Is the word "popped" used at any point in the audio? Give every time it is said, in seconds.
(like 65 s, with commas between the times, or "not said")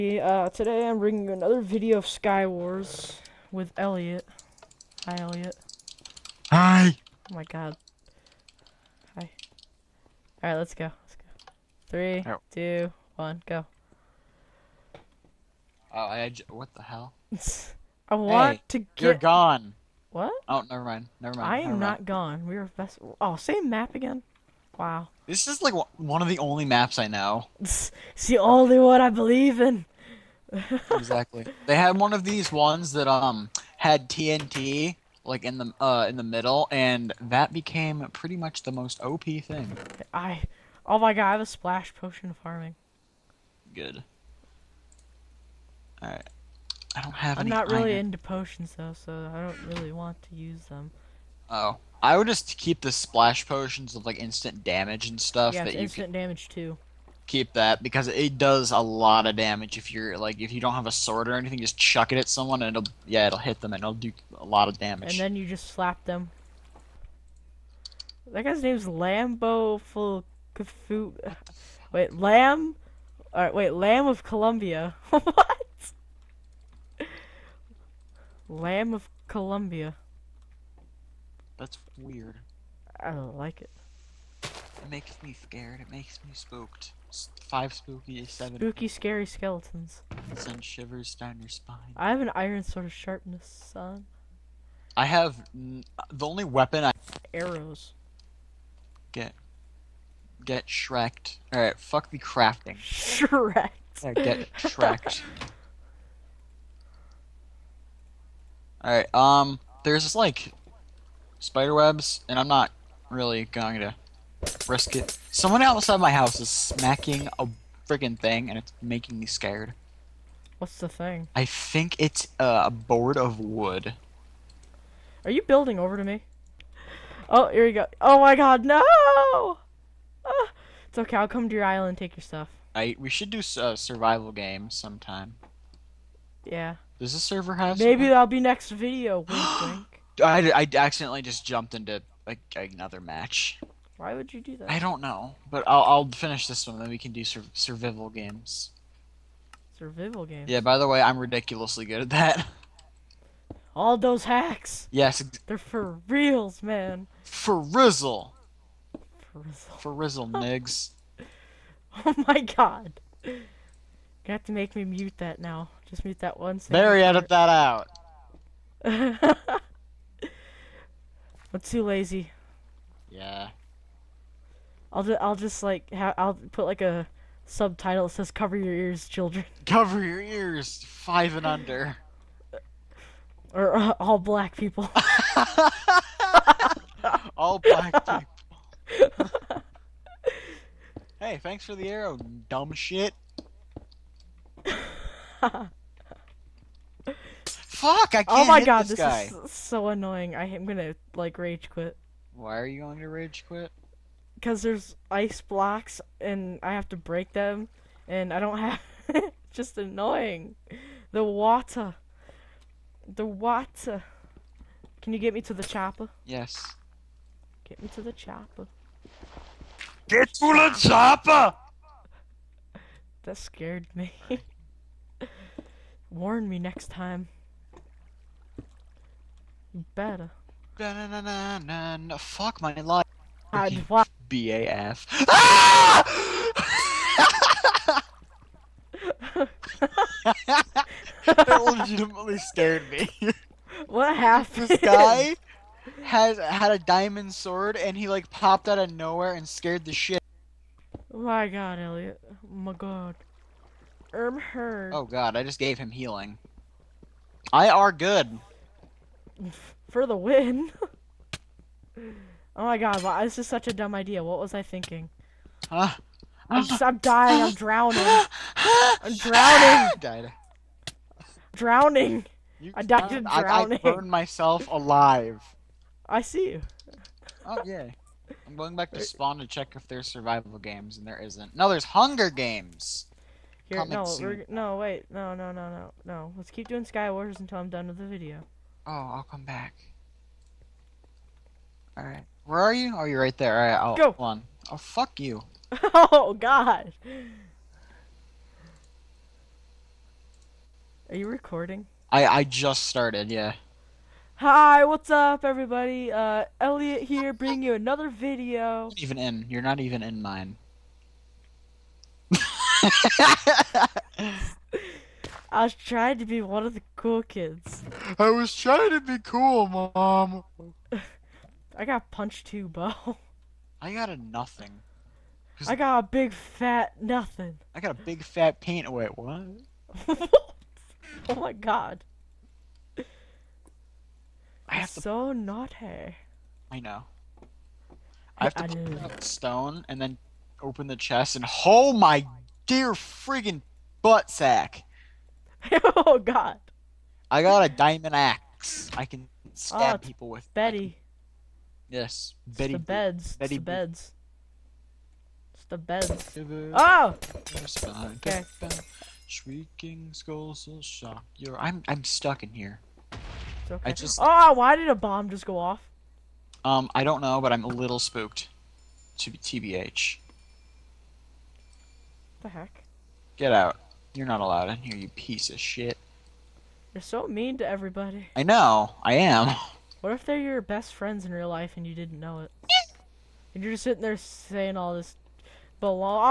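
248 s.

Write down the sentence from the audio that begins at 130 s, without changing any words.
Ah, it's okay, I'll come to your island and take your stuff.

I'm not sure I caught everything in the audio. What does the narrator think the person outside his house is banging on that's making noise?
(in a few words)
a board of wood.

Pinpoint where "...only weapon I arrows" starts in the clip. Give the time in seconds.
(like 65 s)
96 s.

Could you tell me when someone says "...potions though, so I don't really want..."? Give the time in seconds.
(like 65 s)
48 s.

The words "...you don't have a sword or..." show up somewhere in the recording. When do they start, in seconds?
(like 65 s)
60 s.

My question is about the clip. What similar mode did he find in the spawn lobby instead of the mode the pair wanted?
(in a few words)
Hunger Games.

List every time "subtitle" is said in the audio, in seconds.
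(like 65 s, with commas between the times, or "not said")
177 s.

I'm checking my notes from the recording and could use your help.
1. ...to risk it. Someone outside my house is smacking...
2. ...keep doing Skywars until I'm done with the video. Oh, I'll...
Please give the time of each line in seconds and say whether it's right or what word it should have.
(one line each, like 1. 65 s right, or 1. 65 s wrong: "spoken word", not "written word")
1. 113 s right
2. 286 s right.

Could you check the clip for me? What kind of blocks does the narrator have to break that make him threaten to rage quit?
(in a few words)
ice blocks.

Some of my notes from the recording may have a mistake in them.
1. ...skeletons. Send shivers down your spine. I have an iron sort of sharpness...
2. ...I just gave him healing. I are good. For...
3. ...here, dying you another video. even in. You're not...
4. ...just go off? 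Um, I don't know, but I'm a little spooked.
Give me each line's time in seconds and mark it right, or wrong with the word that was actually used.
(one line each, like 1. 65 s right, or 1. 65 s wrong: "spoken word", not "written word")
1. 89 s right
2. 255 s right
3. 307 s wrong: "bringing", not "dying"
4. 365 s right.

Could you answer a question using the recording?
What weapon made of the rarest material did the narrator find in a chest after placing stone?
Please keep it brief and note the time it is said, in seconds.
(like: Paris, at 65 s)
diamond axe, at 347 s.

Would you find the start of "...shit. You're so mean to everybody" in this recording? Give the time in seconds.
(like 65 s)
375 s.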